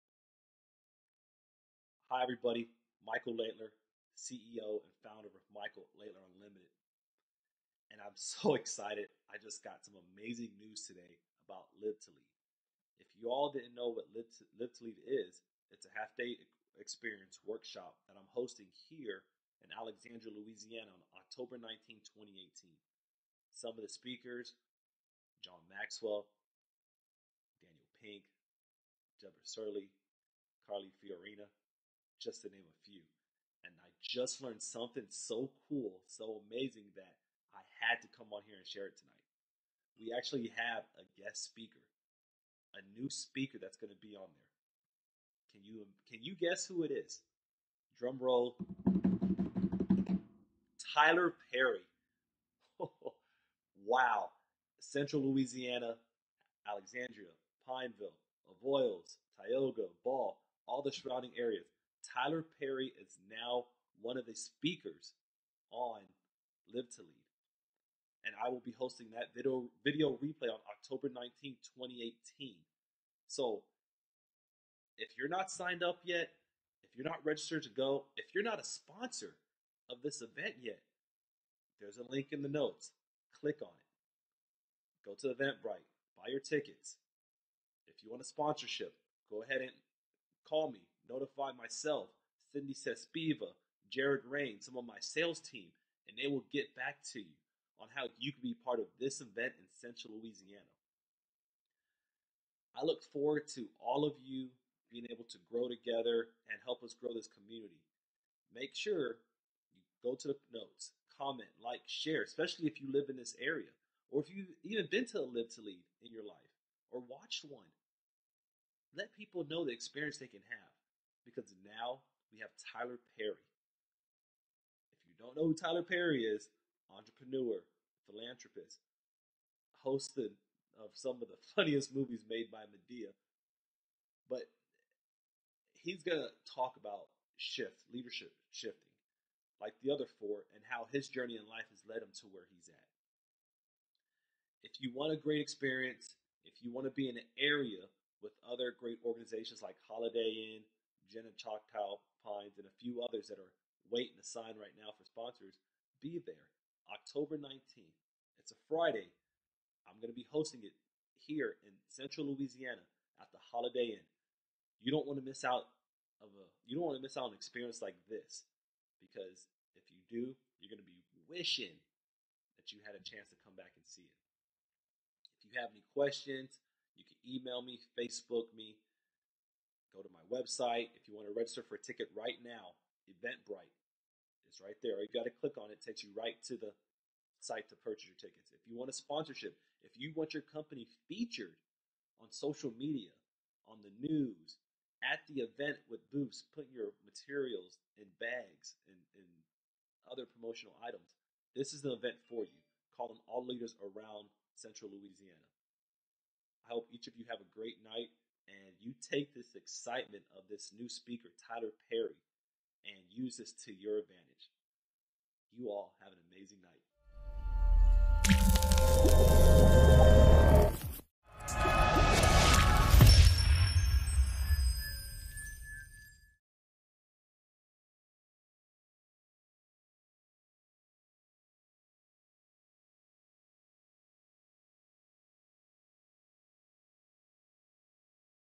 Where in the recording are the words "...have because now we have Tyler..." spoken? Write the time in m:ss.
2:00.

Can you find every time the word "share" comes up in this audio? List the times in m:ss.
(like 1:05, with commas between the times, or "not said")
0:38, 1:51.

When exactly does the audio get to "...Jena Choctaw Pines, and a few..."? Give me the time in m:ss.
2:31.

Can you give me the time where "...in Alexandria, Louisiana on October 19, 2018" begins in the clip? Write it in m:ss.
0:19.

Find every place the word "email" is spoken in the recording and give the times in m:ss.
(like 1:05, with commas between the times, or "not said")
2:57.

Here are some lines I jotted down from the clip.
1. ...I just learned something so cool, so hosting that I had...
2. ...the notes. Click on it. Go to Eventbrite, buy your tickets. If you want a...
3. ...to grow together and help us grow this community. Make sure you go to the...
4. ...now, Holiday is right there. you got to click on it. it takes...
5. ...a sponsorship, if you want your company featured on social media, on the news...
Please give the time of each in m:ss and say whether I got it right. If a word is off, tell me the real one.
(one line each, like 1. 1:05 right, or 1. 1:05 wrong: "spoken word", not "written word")
1. 0:33 wrong: "amazing", not "hosting"
2. 1:22 right
3. 1:45 right
4. 3:02 wrong: "Eventbrite", not "Holiday"
5. 3:08 right.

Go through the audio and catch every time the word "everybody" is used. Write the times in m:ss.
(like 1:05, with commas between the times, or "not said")
0:02.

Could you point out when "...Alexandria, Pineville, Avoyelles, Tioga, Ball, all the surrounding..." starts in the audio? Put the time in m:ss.
0:56.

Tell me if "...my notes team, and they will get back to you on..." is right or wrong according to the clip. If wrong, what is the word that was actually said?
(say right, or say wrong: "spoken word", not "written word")
wrong: "sales", not "notes".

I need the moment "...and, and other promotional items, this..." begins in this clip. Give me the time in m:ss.
3:18.